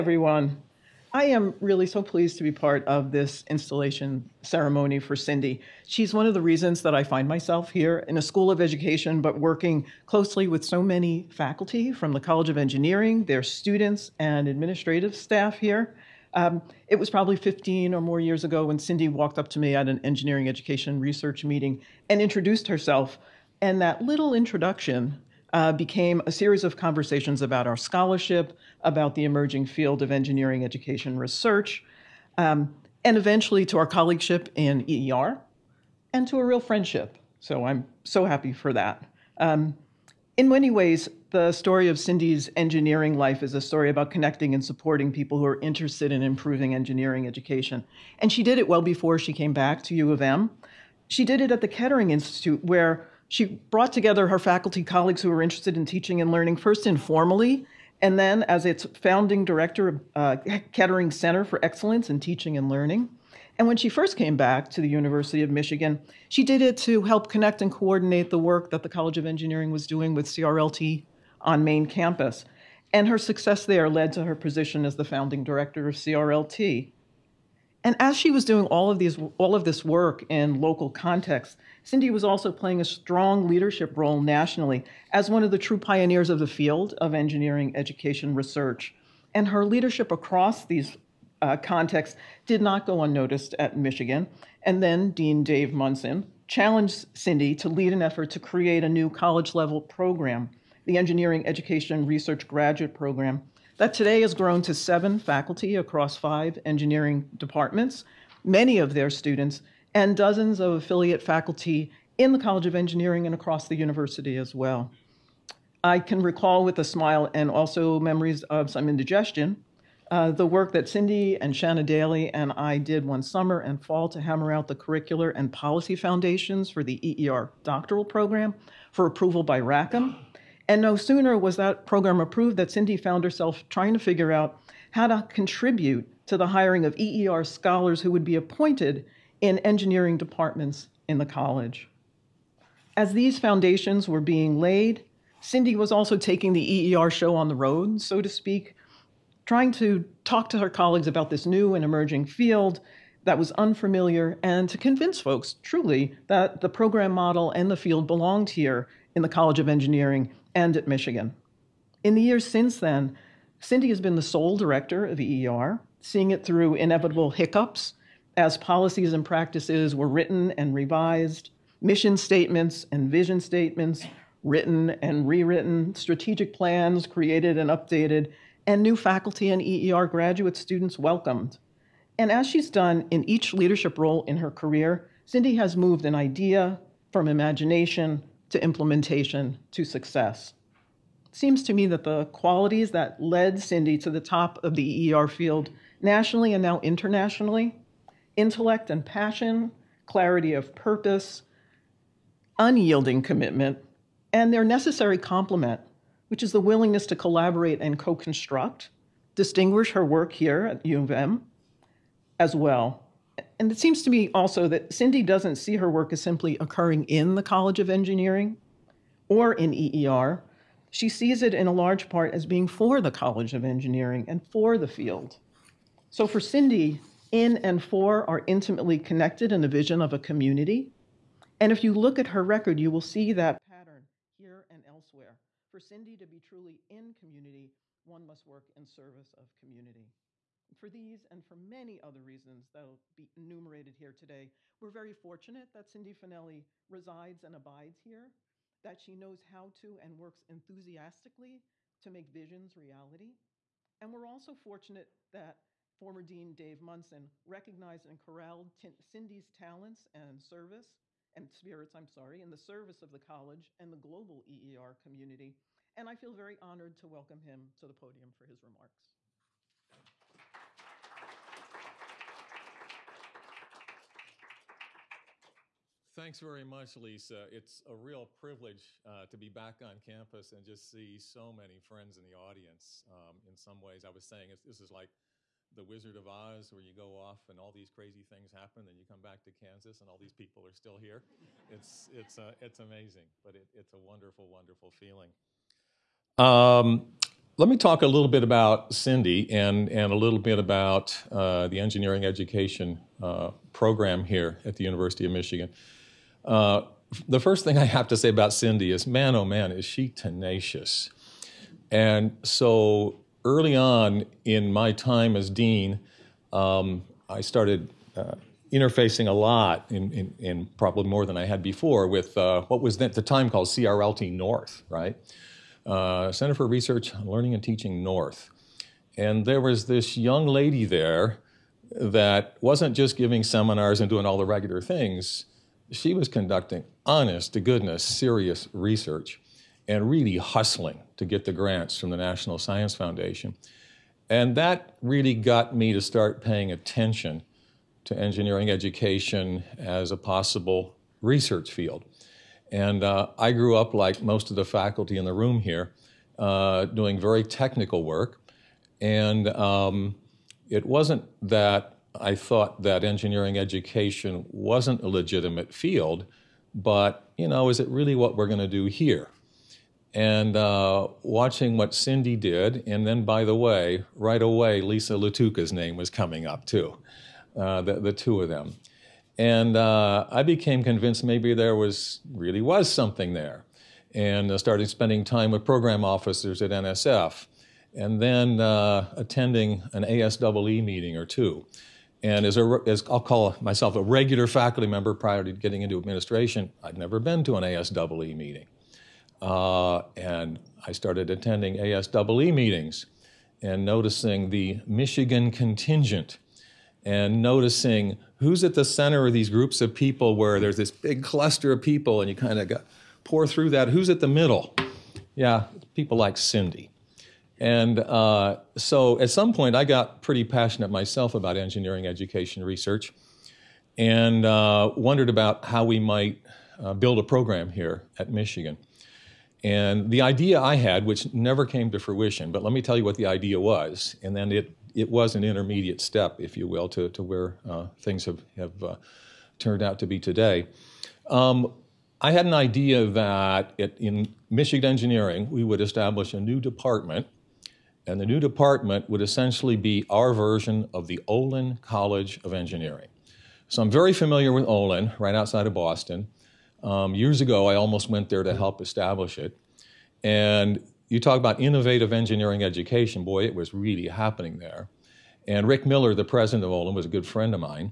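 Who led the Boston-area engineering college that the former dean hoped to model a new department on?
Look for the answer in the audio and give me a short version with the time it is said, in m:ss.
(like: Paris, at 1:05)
Rick Miller, at 7:45.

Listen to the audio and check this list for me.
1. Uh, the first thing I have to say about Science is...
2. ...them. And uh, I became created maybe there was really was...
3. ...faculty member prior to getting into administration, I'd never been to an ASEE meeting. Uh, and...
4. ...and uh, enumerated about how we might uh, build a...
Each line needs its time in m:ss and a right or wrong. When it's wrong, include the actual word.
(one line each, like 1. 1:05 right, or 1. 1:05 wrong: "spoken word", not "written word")
1. 5:06 wrong: "Cindy", not "Science"
2. 6:18 wrong: "convinced", not "created"
3. 6:34 right
4. 7:03 wrong: "wondered", not "enumerated".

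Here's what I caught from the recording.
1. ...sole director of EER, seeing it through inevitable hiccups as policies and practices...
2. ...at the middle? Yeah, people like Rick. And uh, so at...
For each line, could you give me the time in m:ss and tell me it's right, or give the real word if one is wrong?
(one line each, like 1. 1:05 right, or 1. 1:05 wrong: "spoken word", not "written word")
1. 2:44 right
2. 6:54 wrong: "Cindy", not "Rick".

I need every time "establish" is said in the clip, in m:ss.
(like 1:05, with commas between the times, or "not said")
7:25, 7:38.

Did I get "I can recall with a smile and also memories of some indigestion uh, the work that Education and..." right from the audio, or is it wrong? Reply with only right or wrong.
wrong.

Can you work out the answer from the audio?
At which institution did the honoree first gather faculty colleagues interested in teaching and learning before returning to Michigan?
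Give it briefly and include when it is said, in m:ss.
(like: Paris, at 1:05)
Kettering Institute, at 0:51.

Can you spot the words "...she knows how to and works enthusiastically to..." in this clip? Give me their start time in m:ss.
4:08.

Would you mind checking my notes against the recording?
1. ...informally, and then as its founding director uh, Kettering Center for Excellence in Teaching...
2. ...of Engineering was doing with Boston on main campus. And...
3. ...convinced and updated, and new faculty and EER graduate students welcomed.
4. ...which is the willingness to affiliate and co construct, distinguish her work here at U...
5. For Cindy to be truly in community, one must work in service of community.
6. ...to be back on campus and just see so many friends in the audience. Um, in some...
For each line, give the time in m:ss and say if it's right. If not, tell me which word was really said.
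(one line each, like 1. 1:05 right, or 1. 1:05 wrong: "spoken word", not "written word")
1. 0:56 right
2. 1:09 wrong: "CRLT", not "Boston"
3. 2:57 wrong: "created", not "convinced"
4. 3:26 wrong: "collaborate", not "affiliate"
5. 3:55 right
6. 4:39 right.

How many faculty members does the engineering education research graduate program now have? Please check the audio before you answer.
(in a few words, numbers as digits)
7.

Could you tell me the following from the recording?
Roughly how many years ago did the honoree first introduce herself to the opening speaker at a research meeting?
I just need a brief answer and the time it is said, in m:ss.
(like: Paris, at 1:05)
15, at 0:17.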